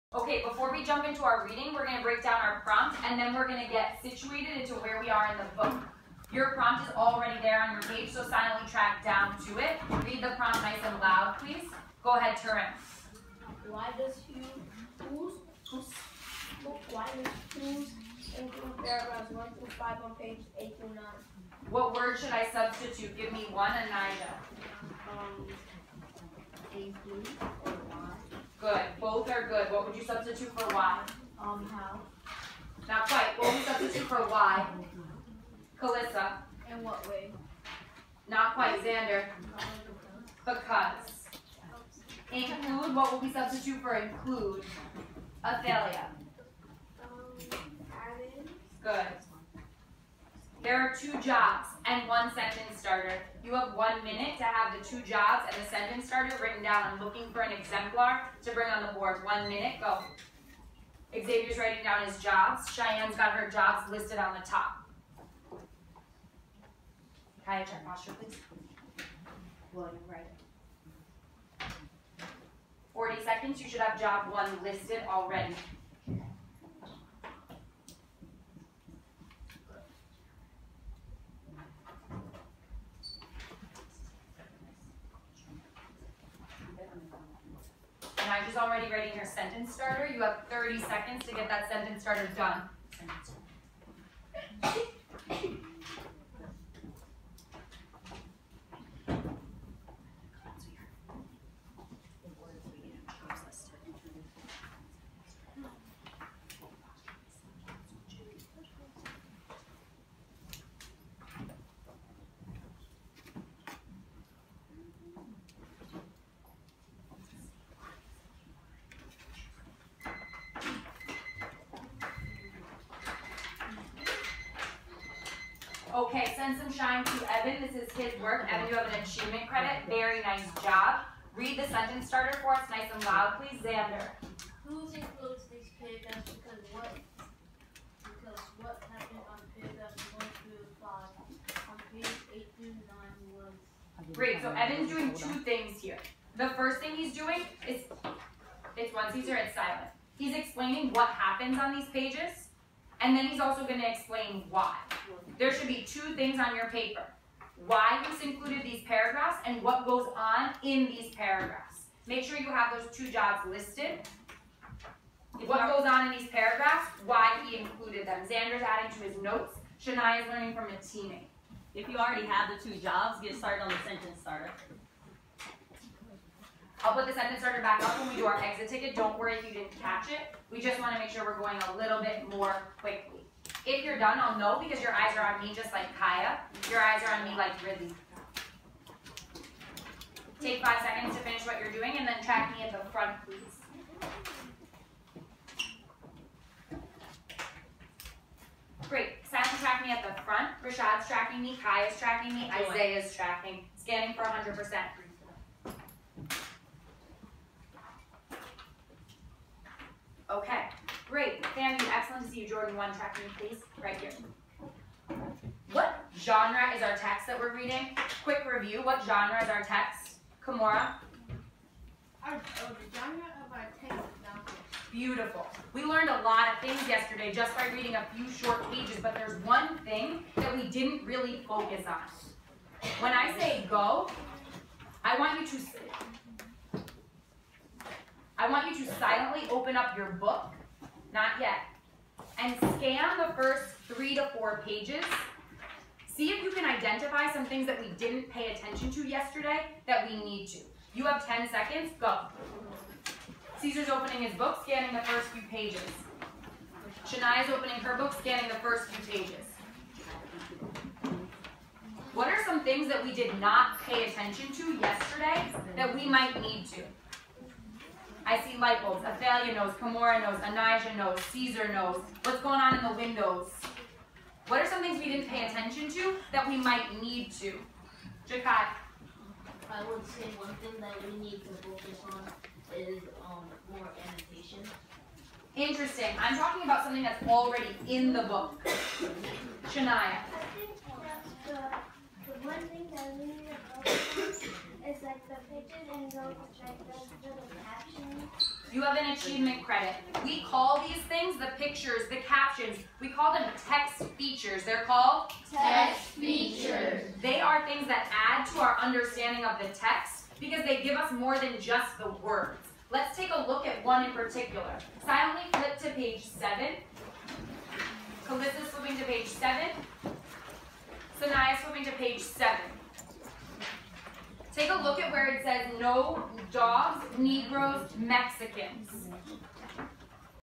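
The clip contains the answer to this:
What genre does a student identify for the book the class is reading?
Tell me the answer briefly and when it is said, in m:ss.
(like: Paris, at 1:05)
nonfiction, at 3:44.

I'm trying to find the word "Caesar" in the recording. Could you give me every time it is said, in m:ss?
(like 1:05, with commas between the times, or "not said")
4:13, 4:31.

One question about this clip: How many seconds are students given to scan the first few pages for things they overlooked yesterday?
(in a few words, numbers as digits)
10.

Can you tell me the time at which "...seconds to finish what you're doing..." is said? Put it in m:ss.
3:10.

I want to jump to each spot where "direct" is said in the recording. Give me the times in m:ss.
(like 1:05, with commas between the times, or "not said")
not said.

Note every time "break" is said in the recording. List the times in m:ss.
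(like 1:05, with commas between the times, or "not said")
0:02.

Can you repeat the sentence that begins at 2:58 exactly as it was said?
Don't worry if you didn't catch it.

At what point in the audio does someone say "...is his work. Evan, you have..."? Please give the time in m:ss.
2:07.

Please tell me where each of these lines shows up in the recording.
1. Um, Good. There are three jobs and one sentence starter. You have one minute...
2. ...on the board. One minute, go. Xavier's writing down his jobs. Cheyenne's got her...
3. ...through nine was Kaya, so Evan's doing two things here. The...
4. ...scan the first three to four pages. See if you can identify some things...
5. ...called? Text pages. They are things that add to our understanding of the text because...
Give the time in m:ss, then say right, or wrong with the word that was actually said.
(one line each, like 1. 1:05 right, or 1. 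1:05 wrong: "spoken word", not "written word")
1. 0:47 wrong: "two", not "three"
2. 0:58 right
3. 2:22 wrong: "Great", not "Kaya"
4. 4:02 right
5. 5:04 wrong: "features", not "pages".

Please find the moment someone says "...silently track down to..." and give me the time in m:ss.
0:08.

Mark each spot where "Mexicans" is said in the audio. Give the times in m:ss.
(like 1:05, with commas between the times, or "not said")
5:27.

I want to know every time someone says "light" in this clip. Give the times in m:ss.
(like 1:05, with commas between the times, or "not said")
4:28.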